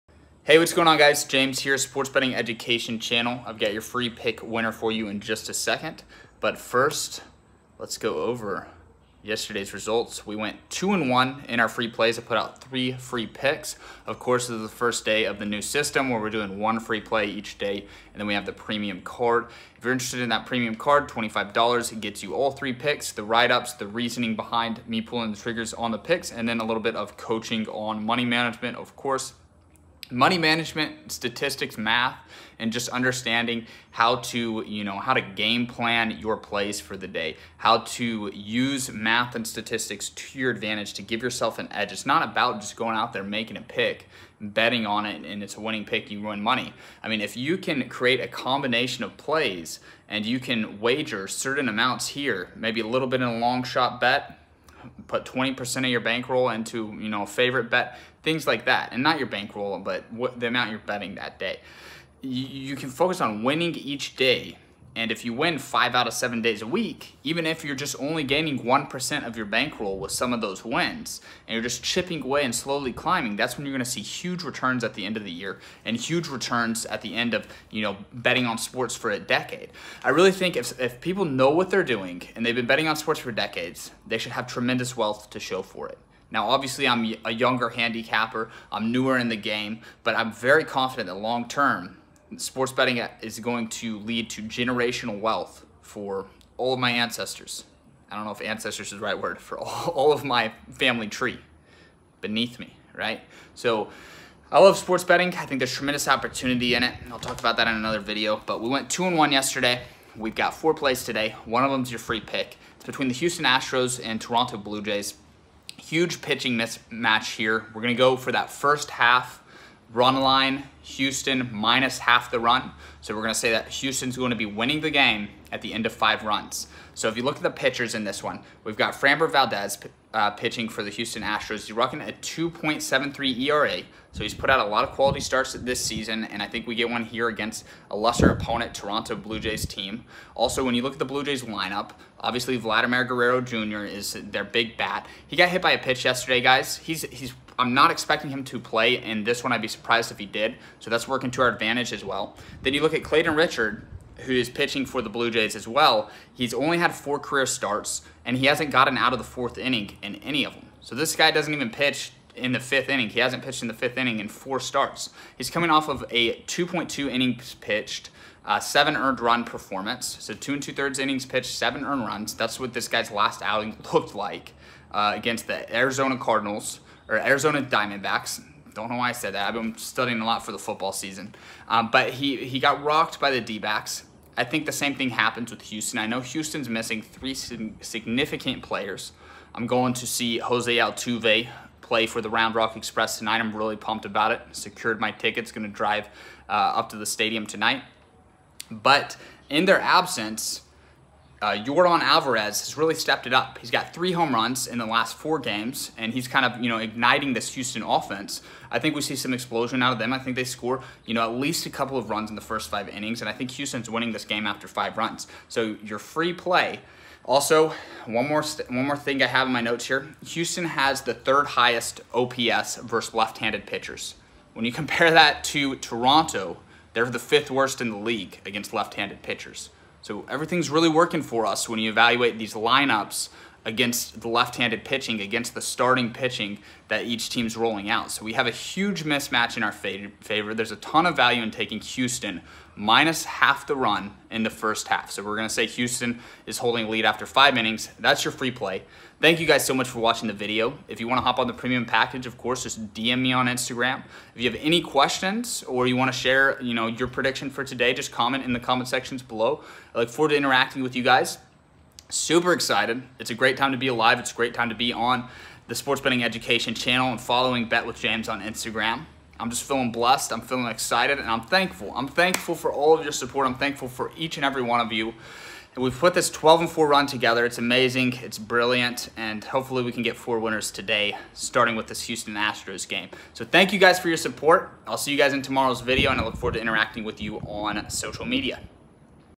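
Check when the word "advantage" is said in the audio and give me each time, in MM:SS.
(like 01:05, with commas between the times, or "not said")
00:40, 02:31.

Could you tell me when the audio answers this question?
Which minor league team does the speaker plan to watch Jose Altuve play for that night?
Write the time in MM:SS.
03:12.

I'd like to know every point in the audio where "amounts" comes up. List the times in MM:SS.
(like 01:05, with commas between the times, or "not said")
00:51, 01:00.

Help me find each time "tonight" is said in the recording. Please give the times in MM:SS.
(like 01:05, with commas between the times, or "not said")
03:13, 03:17.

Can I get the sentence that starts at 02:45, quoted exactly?
He's coming off of a 2.2 innings pitched, uh, seven earned run performance.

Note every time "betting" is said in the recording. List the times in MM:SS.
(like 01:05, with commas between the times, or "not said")
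00:02, 00:44, 01:00, 01:18, 01:22, 01:32, 01:45, 04:26.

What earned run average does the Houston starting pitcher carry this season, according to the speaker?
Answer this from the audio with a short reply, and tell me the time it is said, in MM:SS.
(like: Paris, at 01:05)
2.73, at 02:12.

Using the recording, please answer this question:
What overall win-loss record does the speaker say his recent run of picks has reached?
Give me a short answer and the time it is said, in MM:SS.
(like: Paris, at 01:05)
12 and 4, at 04:36.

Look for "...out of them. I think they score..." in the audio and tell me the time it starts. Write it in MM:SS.
03:29.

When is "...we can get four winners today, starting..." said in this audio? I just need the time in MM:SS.
04:39.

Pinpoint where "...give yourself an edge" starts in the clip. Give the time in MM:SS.
00:41.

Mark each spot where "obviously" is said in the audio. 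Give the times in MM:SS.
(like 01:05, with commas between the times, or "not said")
01:26, 02:22.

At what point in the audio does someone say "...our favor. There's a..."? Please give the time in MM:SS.
03:59.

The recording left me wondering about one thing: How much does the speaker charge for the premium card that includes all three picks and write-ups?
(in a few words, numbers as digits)
$25.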